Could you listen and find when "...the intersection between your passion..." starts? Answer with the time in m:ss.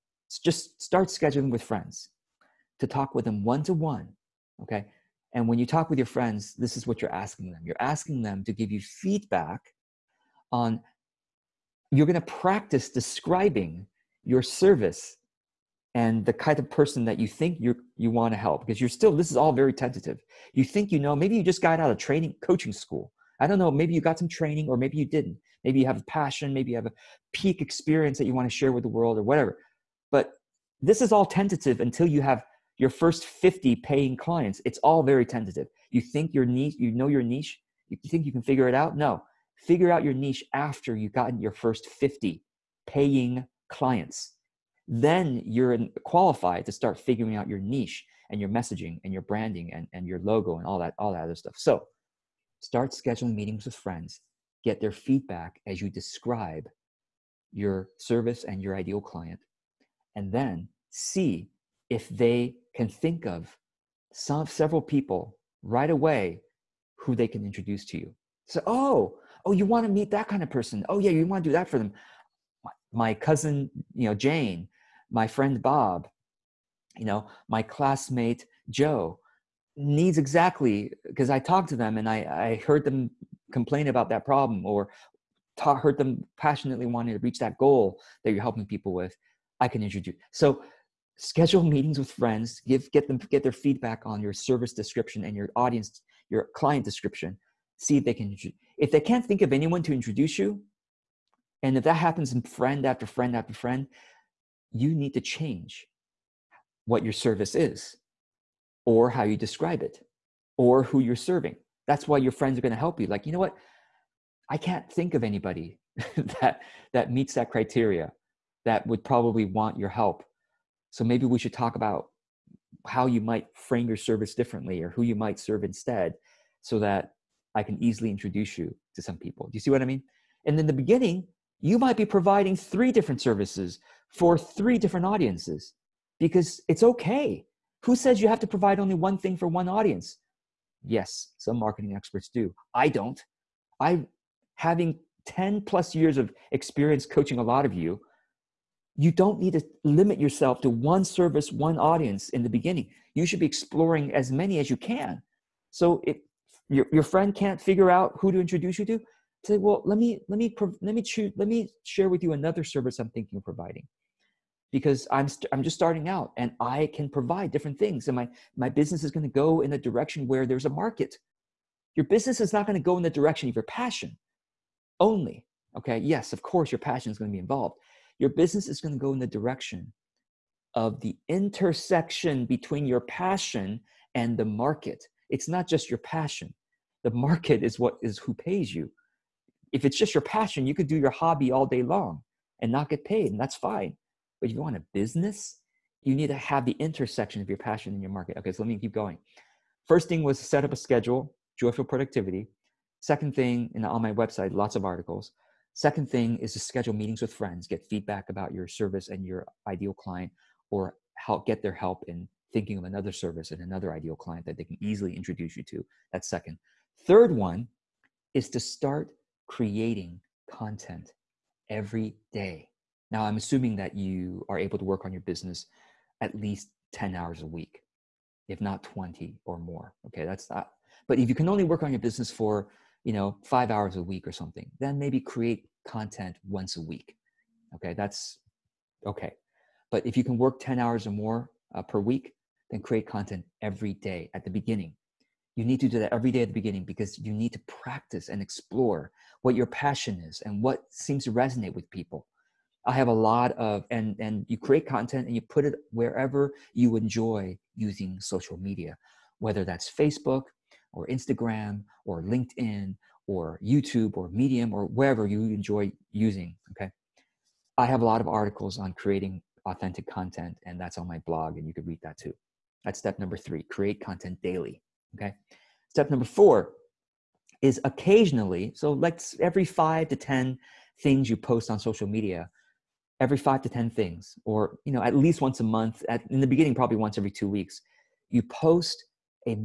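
3:01.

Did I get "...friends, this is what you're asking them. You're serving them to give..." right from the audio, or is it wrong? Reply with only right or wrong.
wrong.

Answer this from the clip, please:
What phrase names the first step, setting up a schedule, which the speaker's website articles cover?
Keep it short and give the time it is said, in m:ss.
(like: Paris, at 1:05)
Joyful productivity, at 3:21.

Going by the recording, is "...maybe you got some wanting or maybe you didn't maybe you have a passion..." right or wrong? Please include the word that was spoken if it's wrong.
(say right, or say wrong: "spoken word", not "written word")
wrong: "training", not "wanting".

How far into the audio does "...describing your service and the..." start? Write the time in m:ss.
0:12.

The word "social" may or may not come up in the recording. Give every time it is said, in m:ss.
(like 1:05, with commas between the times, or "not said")
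4:18, 4:41.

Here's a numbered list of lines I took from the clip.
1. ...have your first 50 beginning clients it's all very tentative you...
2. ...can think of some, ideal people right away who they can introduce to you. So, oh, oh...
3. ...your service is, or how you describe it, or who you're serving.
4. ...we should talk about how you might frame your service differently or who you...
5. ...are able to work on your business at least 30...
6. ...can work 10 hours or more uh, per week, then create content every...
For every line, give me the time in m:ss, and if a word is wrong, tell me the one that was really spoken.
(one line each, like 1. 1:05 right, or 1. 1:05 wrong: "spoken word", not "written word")
1. 0:32 wrong: "paying", not "beginning"
2. 1:02 wrong: "several", not "ideal"
3. 1:47 right
4. 2:01 right
5. 3:44 wrong: "10", not "30"
6. 4:00 right.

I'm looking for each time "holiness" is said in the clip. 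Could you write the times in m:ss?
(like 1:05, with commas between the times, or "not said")
not said.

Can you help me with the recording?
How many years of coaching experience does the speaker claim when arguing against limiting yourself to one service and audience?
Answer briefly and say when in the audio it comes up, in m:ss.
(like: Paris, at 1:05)
10 plus, at 2:25.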